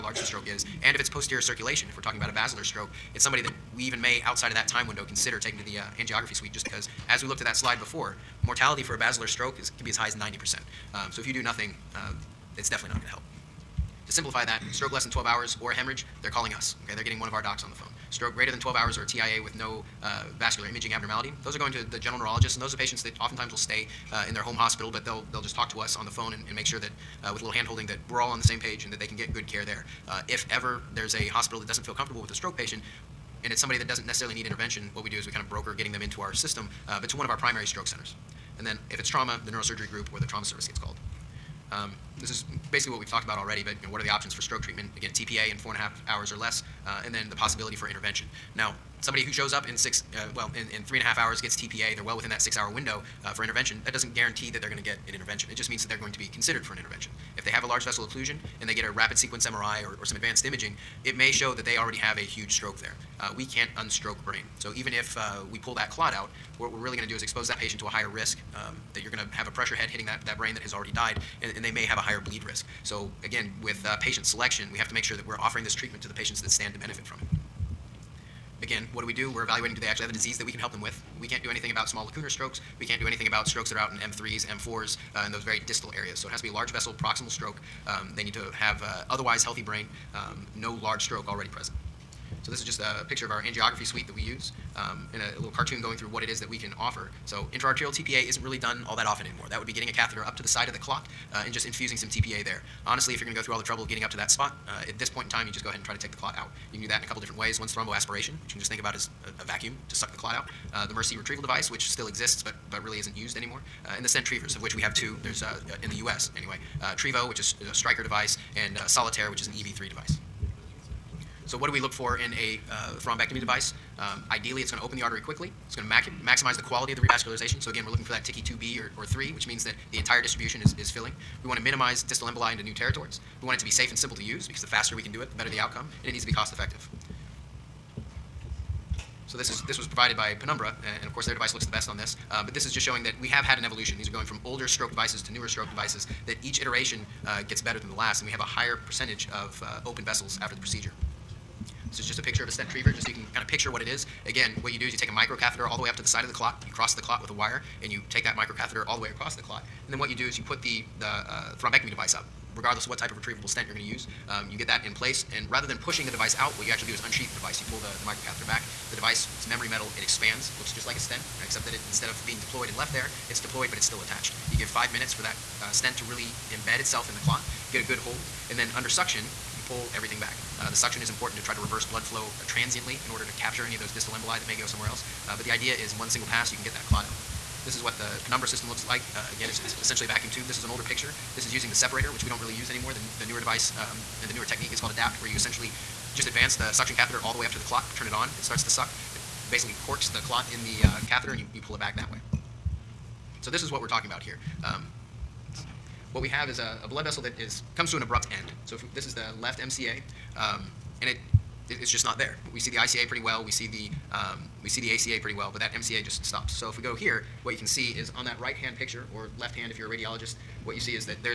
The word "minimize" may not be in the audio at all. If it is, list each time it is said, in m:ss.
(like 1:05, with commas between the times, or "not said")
2:11.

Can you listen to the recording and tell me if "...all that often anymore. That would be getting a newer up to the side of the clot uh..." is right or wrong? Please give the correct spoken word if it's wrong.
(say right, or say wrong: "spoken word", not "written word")
wrong: "catheter", not "newer".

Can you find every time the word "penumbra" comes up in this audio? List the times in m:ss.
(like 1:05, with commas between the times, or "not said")
2:20, 3:08.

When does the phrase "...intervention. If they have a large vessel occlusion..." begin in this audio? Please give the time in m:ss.
0:56.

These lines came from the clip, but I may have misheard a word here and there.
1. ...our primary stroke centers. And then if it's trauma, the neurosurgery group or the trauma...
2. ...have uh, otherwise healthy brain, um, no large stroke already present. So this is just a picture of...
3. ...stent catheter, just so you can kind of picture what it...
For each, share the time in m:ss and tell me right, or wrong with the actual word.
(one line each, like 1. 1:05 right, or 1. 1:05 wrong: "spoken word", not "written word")
1. 0:37 right
2. 1:28 right
3. 2:32 wrong: "retriever", not "catheter".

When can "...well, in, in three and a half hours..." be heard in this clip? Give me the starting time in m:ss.
0:50.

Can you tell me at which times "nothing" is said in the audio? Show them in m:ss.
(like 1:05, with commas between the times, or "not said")
0:11.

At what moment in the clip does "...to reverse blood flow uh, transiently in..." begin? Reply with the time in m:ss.
3:01.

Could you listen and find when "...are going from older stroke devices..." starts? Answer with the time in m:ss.
2:24.